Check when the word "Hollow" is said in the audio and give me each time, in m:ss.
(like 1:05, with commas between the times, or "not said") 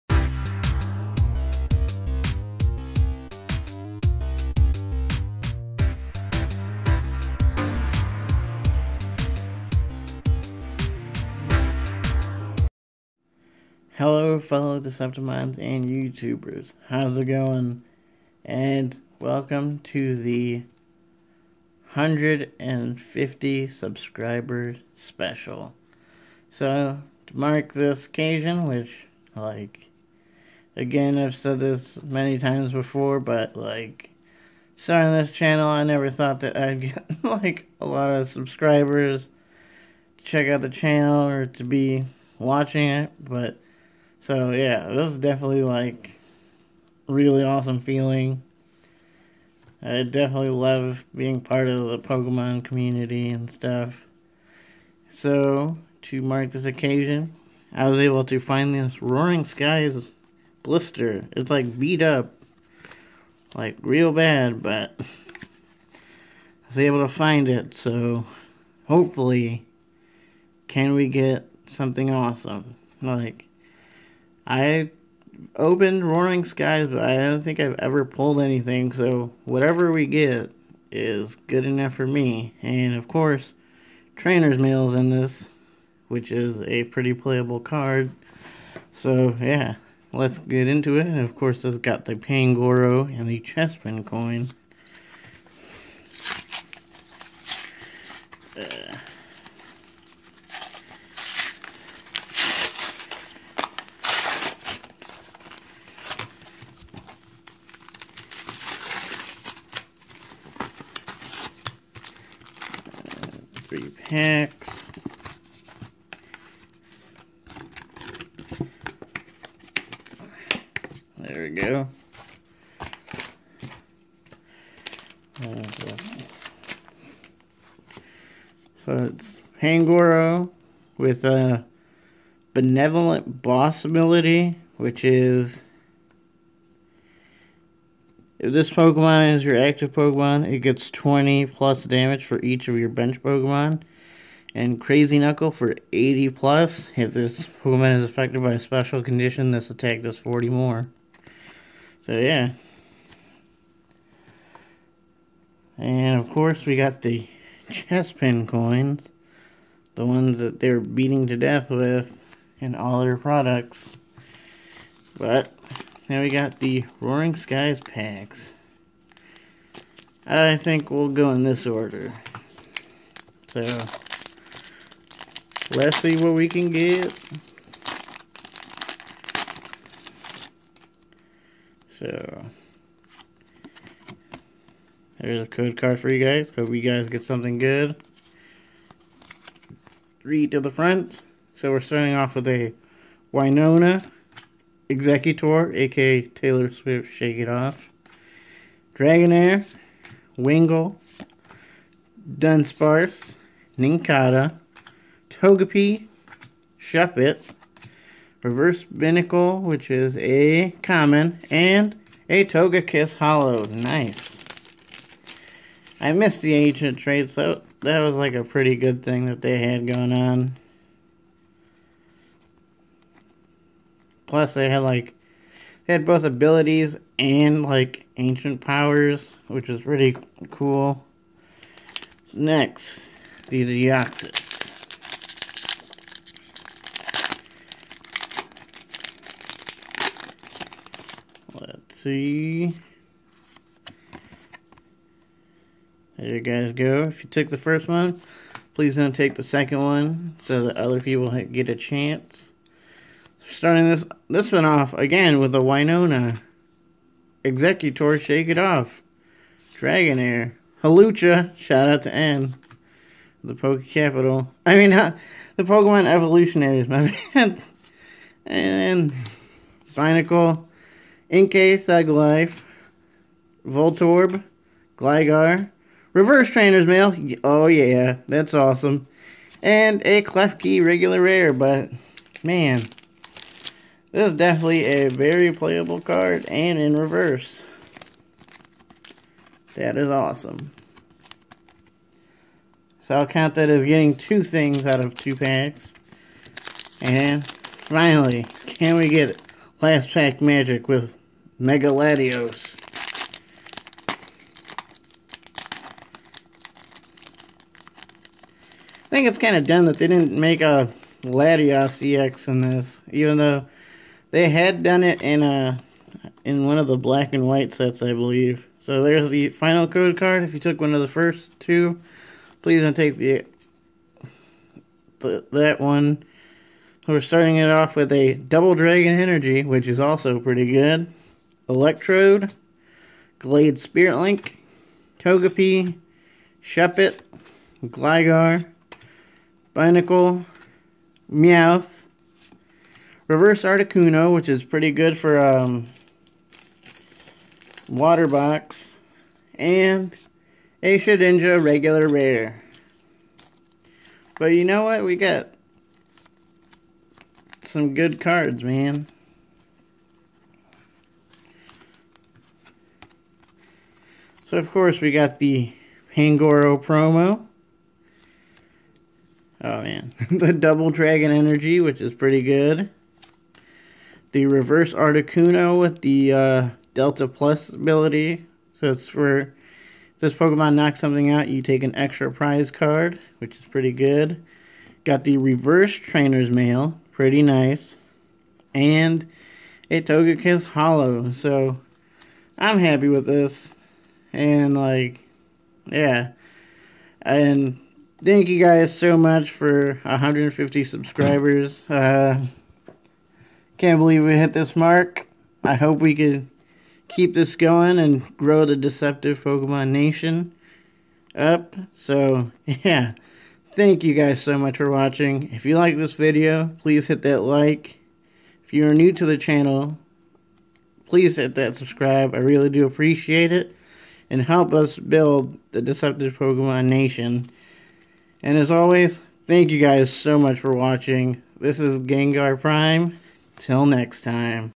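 3:33, 6:30.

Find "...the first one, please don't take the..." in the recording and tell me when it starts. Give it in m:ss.
4:07.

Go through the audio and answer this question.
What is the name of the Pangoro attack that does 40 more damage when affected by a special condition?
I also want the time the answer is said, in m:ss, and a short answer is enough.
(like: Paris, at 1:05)
Crazy Knuckle, at 2:24.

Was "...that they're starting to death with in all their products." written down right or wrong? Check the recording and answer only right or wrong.
wrong.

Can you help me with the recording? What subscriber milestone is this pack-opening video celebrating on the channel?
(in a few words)
150.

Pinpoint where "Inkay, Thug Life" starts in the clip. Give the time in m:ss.
4:31.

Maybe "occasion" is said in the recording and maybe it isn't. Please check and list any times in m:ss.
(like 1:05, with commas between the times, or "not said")
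0:28, 0:56.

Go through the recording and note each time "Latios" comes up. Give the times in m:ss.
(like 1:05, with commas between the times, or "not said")
5:01, 5:11.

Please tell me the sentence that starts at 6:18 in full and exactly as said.
So it's for this Pokemon knocks something out, you take an extra prize card, which is pretty good.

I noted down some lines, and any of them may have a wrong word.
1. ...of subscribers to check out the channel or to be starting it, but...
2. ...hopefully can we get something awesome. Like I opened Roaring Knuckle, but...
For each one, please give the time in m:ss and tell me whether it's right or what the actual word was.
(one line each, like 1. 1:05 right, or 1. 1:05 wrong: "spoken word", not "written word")
1. 0:38 wrong: "watching", not "starting"
2. 1:08 wrong: "Skies", not "Knuckle".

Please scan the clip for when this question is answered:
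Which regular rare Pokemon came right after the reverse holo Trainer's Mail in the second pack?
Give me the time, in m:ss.
4:40.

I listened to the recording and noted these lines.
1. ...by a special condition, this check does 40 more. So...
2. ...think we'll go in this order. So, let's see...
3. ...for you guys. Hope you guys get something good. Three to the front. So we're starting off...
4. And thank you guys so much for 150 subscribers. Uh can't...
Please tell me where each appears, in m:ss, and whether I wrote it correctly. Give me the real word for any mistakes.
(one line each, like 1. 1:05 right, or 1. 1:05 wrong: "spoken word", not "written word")
1. 2:28 wrong: "attack", not "check"
2. 2:50 right
3. 3:05 right
4. 6:37 right.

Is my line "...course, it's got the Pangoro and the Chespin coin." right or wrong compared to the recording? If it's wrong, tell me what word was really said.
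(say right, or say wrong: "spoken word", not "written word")
right.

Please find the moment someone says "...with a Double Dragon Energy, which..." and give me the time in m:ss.
5:27.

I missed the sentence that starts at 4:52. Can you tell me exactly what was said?
So I'll count that as getting two things out of two packs.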